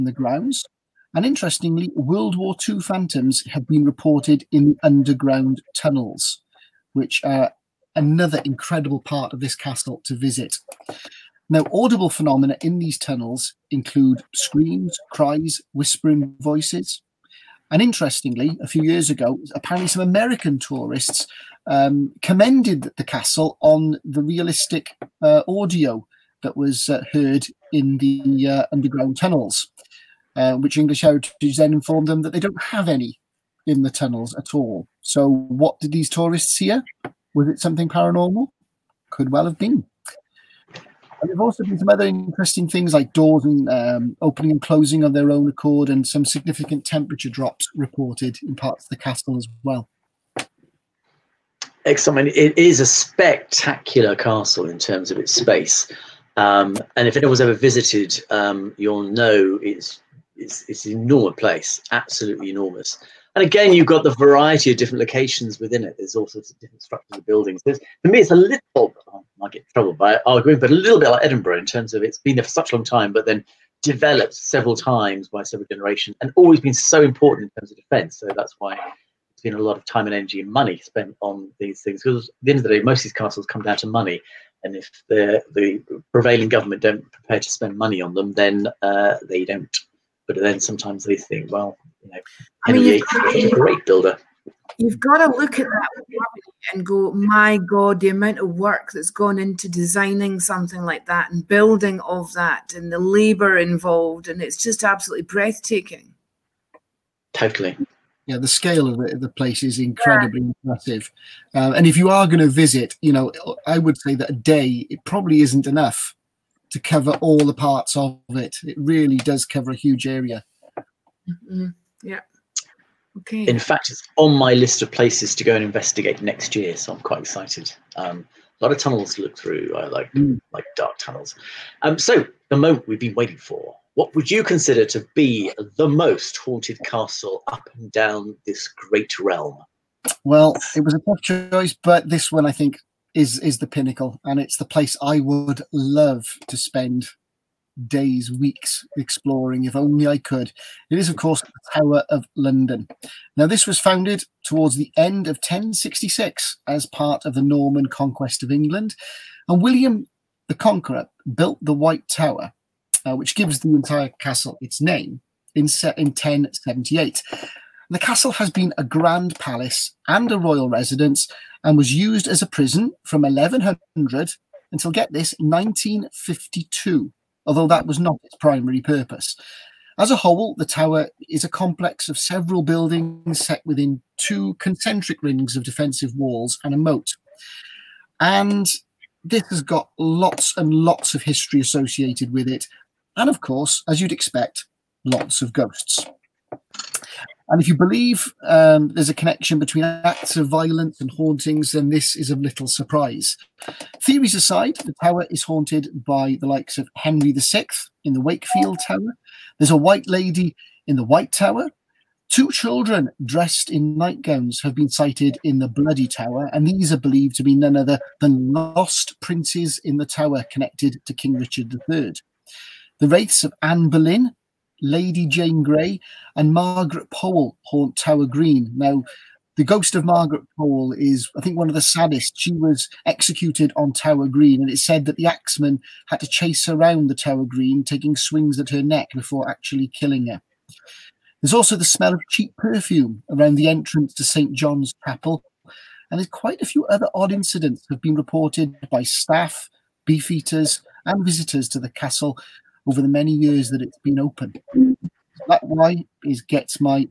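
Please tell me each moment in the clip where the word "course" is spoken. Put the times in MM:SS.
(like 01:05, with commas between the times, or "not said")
02:31, 03:13.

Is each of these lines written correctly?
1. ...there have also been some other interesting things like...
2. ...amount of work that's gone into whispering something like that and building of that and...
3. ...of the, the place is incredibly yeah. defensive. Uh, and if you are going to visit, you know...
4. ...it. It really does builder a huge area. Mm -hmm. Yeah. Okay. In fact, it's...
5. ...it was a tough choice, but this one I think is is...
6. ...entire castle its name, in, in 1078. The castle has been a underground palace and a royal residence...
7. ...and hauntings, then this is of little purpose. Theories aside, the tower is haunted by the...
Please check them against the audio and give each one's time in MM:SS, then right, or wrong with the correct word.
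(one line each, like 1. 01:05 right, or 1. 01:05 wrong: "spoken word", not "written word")
1. 00:41 right
2. 01:38 wrong: "designing", not "whispering"
3. 01:48 wrong: "impressive", not "defensive"
4. 01:58 wrong: "cover", not "builder"
5. 02:20 right
6. 02:43 wrong: "grand", not "underground"
7. 03:20 wrong: "surprise", not "purpose".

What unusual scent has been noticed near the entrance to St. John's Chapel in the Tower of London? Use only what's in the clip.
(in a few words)
Cheap perfume.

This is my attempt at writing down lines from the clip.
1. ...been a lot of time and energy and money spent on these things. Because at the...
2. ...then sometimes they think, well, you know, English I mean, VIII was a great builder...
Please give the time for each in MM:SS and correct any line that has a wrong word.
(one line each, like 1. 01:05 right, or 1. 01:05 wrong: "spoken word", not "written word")
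1. 01:19 right
2. 01:30 wrong: "Henry", not "English".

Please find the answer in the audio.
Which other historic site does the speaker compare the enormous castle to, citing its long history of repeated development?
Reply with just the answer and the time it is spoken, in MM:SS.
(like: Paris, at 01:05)
Edinburgh, at 01:11.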